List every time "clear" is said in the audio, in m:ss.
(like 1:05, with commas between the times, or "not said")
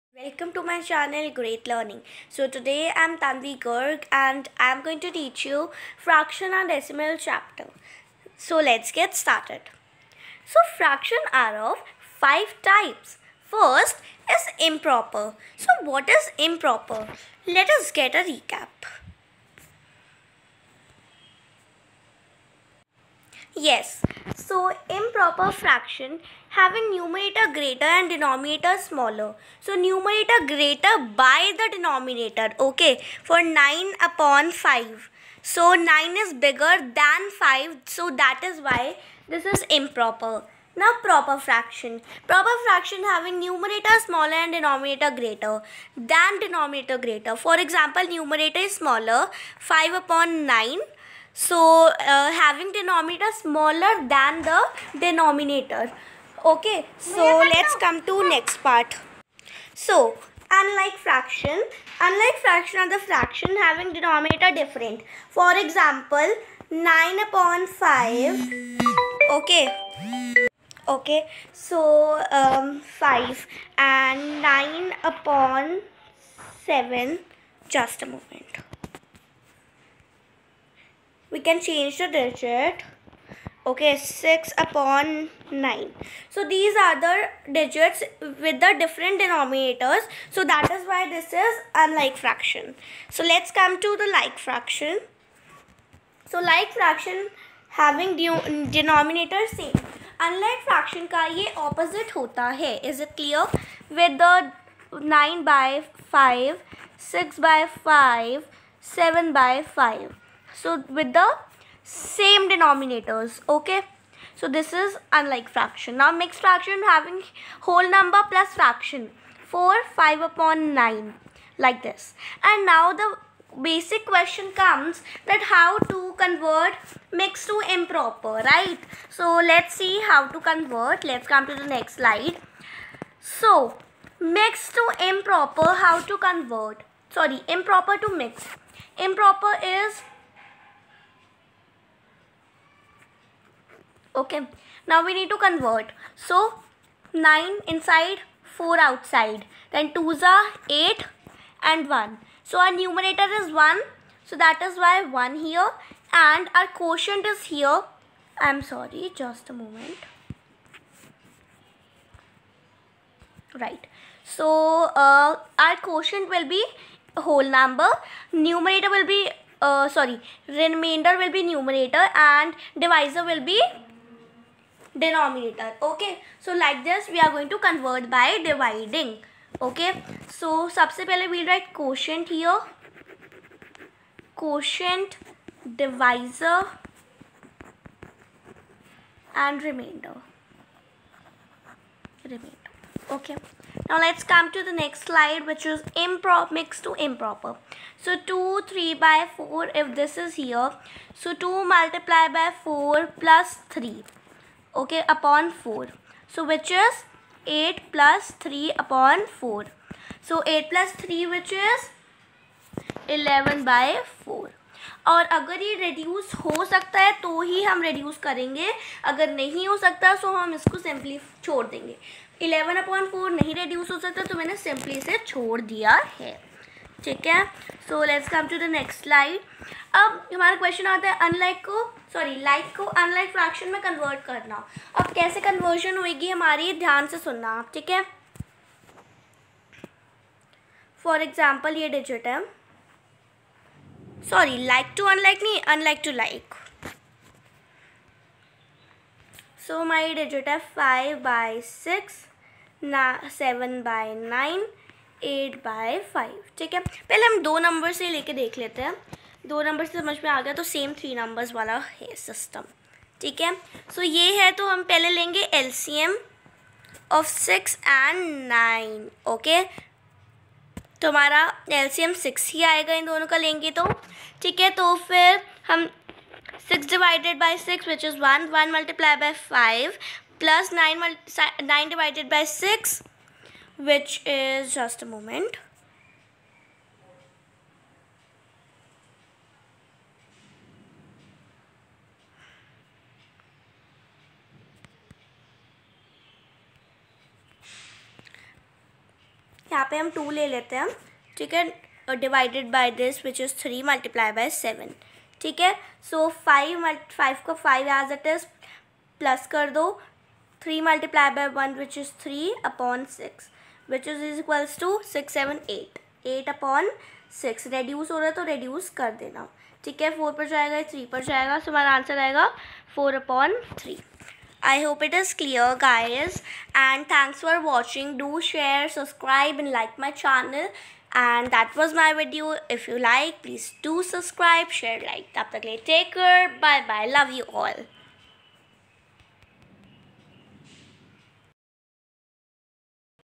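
1:43, 5:25.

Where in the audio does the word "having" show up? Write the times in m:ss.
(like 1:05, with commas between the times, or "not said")
0:26, 0:43, 0:52, 1:03, 1:37, 1:56.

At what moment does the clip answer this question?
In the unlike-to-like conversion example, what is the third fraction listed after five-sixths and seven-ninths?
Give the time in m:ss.
4:15.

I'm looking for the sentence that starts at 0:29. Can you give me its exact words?
So numerator greater by the denominator.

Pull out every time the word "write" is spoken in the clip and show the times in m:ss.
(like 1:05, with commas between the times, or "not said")
3:01.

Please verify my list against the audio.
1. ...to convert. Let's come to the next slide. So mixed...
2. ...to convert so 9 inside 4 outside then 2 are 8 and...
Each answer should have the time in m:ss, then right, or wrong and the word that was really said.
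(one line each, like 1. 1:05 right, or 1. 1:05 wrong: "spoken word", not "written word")
1. 2:10 right
2. 2:25 right.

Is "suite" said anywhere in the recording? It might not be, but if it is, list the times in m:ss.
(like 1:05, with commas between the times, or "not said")
not said.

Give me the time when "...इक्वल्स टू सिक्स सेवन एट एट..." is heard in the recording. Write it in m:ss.
5:14.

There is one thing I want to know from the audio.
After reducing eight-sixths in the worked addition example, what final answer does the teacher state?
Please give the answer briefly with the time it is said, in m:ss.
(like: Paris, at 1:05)
4/3, at 5:22.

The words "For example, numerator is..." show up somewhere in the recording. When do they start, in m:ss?
0:47.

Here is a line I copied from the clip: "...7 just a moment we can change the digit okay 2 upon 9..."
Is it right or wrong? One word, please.
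wrong.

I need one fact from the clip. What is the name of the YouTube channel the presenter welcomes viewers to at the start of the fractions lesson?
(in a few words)
Great Learning.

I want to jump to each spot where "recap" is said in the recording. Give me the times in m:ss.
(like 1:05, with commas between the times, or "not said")
0:18.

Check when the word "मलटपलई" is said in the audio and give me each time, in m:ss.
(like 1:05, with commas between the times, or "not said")
4:38, 5:03, 5:10.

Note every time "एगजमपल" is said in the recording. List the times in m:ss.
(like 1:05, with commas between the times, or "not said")
4:01.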